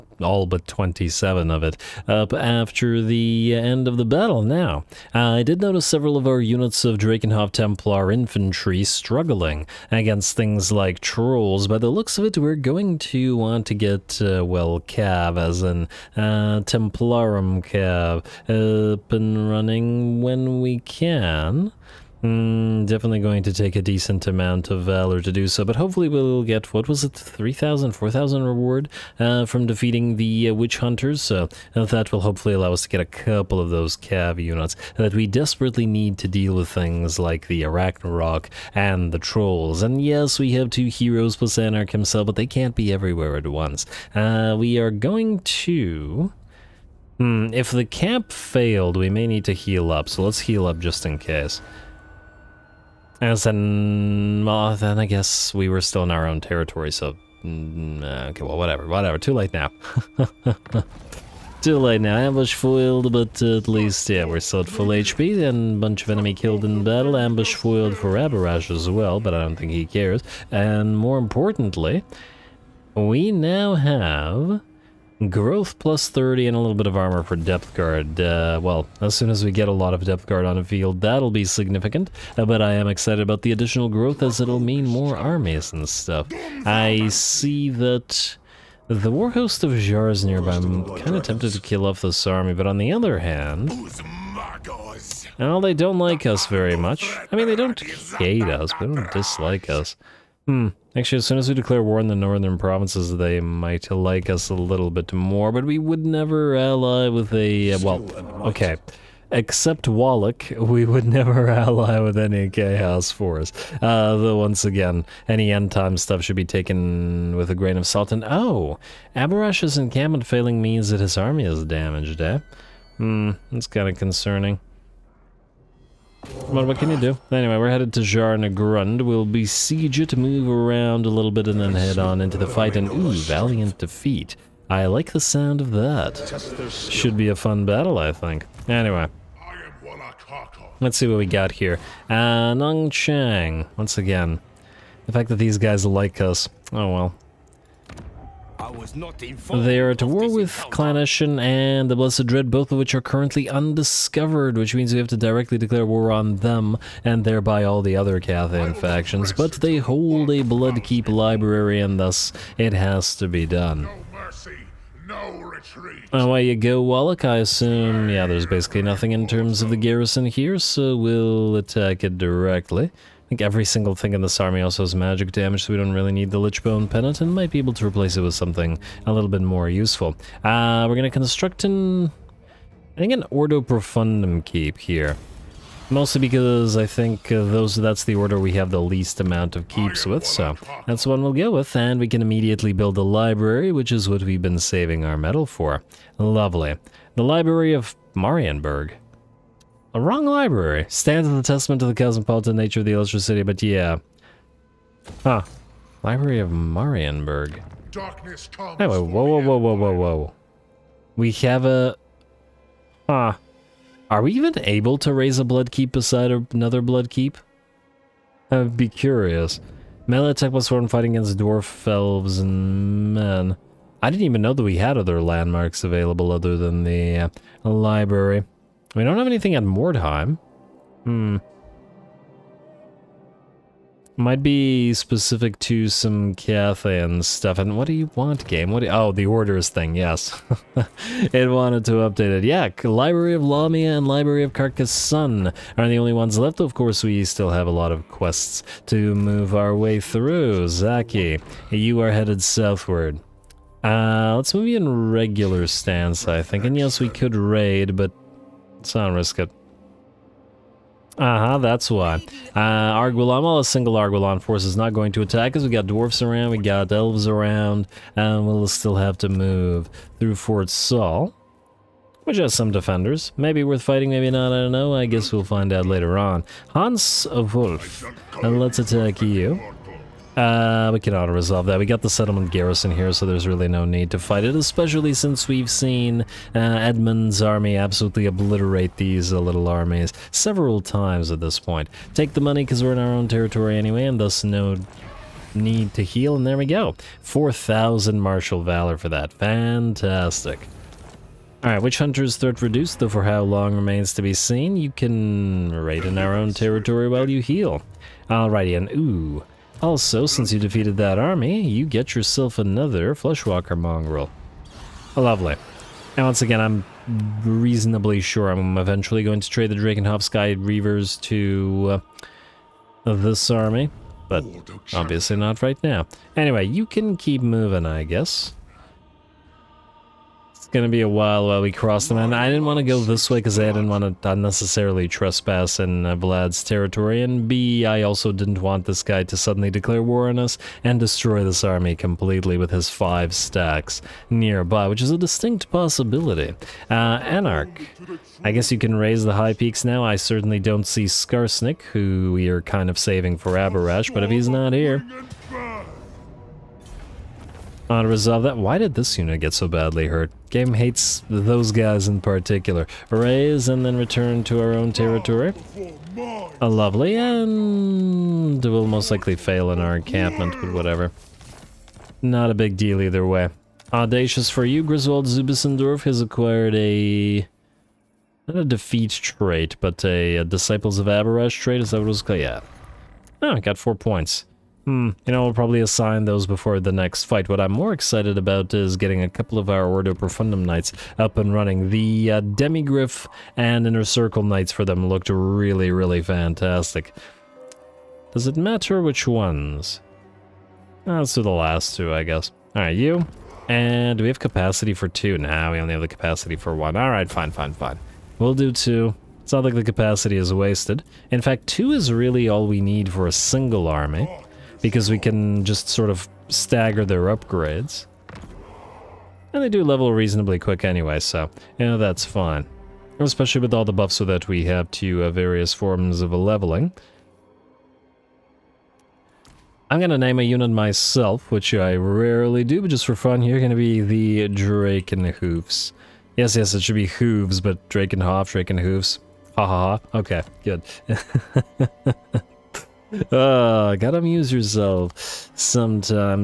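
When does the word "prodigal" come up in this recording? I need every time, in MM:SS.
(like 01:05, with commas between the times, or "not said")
not said.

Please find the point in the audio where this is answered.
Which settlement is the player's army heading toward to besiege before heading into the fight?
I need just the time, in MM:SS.
02:08.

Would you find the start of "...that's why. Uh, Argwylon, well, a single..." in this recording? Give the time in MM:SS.
04:21.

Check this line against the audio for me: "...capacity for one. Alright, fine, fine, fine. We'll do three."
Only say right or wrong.
wrong.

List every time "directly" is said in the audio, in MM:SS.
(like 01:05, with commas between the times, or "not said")
02:35, 02:52.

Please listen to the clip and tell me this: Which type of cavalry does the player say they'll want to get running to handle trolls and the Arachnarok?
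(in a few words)
Templarum Cav.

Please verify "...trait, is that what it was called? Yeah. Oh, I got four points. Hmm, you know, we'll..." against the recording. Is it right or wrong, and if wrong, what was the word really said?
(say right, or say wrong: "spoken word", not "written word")
right.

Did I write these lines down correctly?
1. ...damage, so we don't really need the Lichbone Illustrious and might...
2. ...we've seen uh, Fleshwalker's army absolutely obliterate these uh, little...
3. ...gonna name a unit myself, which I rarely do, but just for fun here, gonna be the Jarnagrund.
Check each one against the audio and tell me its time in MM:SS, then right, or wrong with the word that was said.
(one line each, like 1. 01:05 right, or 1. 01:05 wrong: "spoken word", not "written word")
1. 02:55 wrong: "Pennant", not "Illustrious"
2. 04:45 wrong: "Edmund", not "Fleshwalker"
3. 07:10 wrong: "Drakenhoofs", not "Jarnagrund".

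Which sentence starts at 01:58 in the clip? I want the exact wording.
And, oh, Abhorash's encampment failing means that his army is damaged, eh?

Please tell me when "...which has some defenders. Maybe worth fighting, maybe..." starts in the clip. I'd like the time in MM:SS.
04:32.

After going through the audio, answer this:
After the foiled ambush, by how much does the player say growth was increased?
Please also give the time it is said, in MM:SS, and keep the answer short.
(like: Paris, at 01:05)
30, at 01:16.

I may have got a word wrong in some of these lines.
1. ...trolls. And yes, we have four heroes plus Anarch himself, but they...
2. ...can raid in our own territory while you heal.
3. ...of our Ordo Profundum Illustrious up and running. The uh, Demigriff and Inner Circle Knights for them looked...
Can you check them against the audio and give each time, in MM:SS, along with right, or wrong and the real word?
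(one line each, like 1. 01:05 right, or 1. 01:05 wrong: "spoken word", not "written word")
1. 00:39 wrong: "two", not "four"
2. 05:04 right
3. 06:29 wrong: "Knights", not "Illustrious".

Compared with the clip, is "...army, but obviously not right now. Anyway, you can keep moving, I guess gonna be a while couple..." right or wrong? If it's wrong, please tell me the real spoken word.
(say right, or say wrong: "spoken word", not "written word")
wrong: "while", not "couple".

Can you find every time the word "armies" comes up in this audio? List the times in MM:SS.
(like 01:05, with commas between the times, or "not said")
01:25, 04:49.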